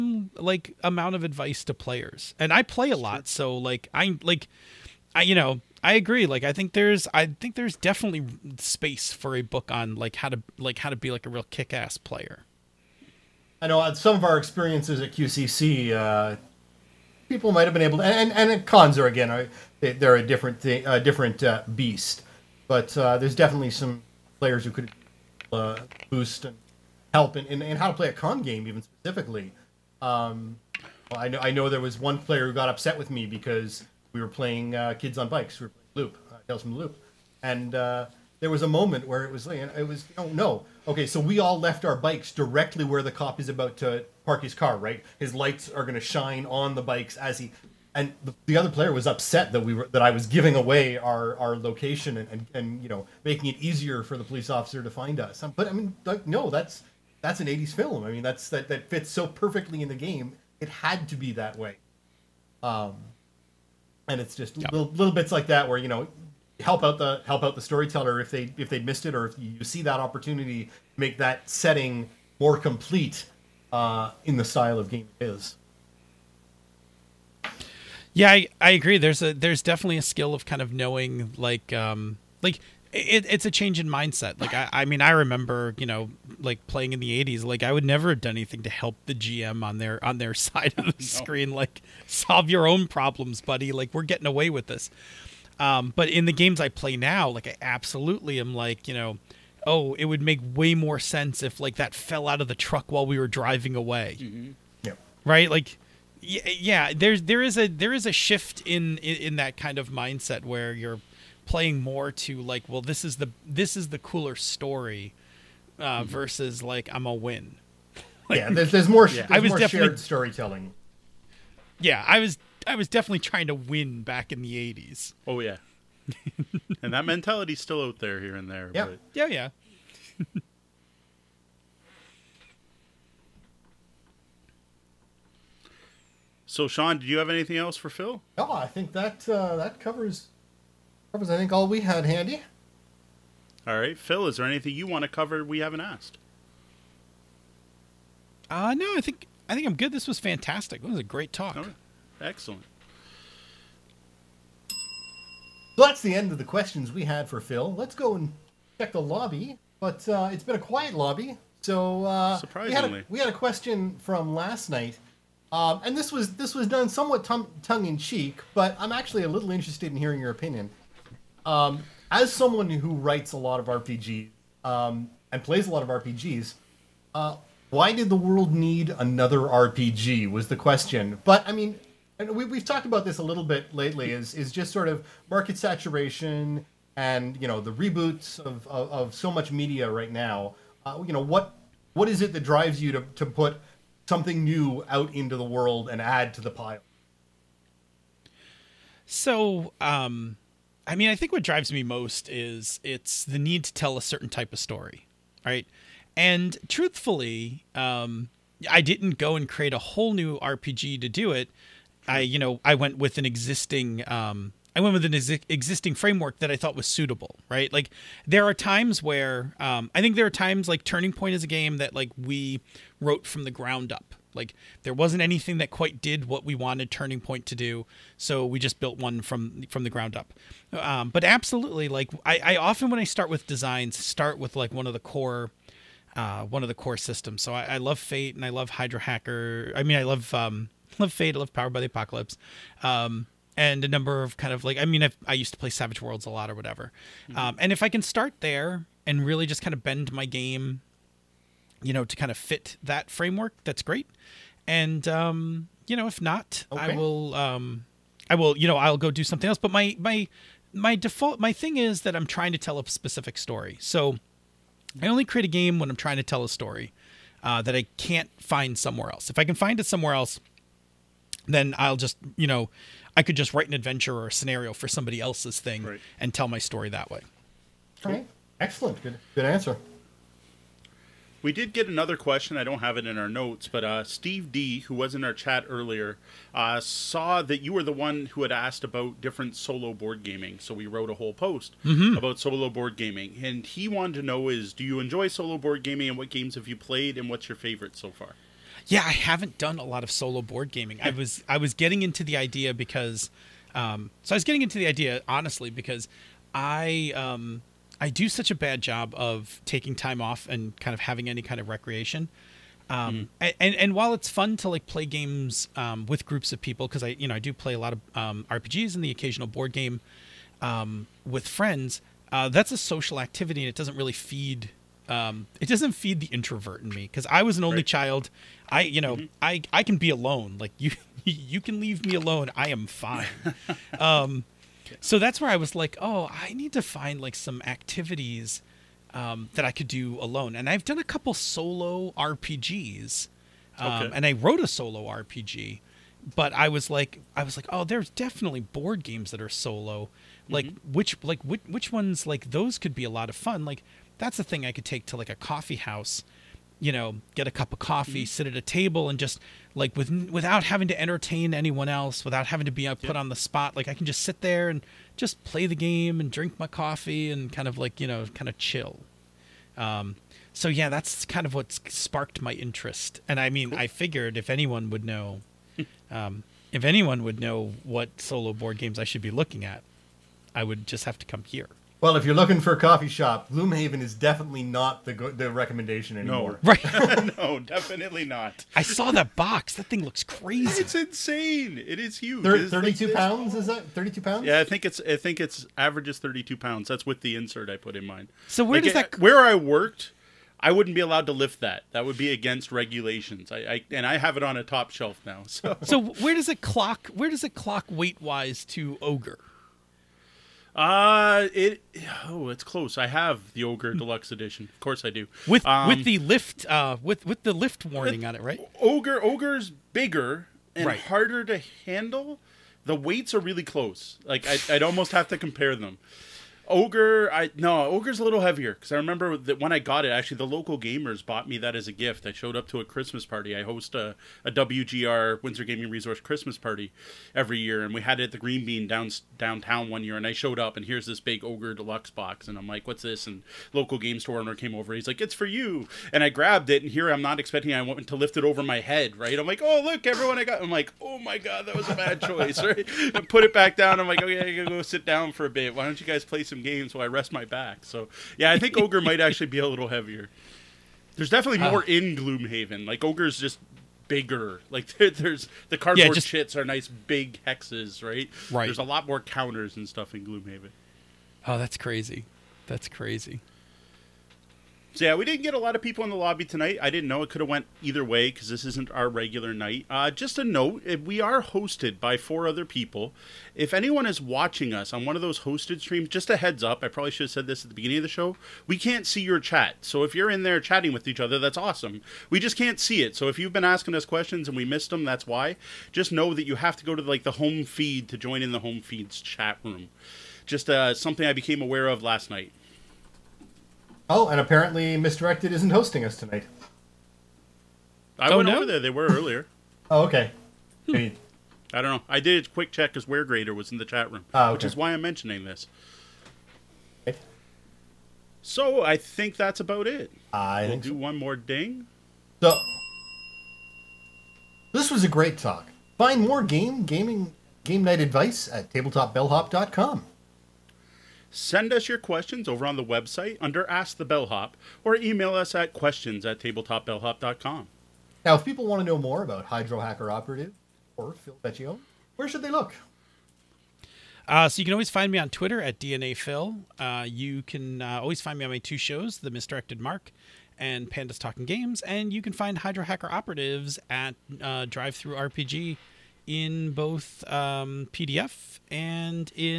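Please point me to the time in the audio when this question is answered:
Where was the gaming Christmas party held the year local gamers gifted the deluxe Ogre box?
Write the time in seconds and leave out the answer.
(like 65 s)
438 s.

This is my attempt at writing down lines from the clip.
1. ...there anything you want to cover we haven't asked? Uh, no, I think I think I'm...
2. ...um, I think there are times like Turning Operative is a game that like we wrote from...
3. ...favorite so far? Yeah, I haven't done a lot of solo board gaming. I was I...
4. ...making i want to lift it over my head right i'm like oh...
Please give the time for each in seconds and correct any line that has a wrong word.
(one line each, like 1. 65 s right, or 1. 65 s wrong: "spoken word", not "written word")
1. 144 s right
2. 219 s wrong: "Point", not "Operative"
3. 297 s right
4. 447 s wrong: "expecting", not "making".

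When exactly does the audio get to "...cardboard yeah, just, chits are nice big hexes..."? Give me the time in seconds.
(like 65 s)
465 s.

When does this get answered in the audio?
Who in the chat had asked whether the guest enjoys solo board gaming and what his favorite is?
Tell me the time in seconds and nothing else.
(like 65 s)
284 s.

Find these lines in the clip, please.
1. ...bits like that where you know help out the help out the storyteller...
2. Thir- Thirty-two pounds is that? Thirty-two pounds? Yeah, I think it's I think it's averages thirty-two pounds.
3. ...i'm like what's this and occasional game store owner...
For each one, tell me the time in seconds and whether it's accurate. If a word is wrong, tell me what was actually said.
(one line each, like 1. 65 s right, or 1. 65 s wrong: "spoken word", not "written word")
1. 65 s right
2. 392 s right
3. 442 s wrong: "local", not "occasional".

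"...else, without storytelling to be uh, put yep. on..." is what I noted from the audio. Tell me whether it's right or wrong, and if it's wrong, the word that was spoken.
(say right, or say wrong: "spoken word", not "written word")
wrong: "having", not "storytelling".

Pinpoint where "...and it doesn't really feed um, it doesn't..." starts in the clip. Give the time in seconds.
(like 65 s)
323 s.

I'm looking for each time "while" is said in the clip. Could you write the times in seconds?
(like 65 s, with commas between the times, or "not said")
102 s, 313 s, 456 s.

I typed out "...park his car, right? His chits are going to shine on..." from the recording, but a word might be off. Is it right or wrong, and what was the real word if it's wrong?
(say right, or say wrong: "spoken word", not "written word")
wrong: "lights", not "chits".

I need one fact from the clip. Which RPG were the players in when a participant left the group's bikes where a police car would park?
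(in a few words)
Tales from the Loop.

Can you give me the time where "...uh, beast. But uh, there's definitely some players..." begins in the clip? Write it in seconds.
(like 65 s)
21 s.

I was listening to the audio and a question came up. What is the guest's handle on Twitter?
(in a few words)
DNA Phil.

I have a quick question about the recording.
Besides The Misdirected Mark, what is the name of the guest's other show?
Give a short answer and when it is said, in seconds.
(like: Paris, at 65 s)
Pandas Talking Games, at 550 s.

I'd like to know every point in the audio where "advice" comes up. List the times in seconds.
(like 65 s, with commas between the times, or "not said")
1 s, 528 s.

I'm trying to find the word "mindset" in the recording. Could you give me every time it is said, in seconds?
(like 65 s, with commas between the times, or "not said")
83 s, 109 s.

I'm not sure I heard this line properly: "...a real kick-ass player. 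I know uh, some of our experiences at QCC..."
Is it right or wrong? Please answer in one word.
right.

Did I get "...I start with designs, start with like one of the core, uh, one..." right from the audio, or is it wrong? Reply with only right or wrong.
right.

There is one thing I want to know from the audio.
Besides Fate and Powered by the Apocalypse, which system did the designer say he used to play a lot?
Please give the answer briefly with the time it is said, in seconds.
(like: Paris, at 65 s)
Savage Worlds, at 245 s.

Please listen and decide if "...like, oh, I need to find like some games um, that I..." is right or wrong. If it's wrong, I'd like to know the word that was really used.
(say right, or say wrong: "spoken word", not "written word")
wrong: "activities", not "games".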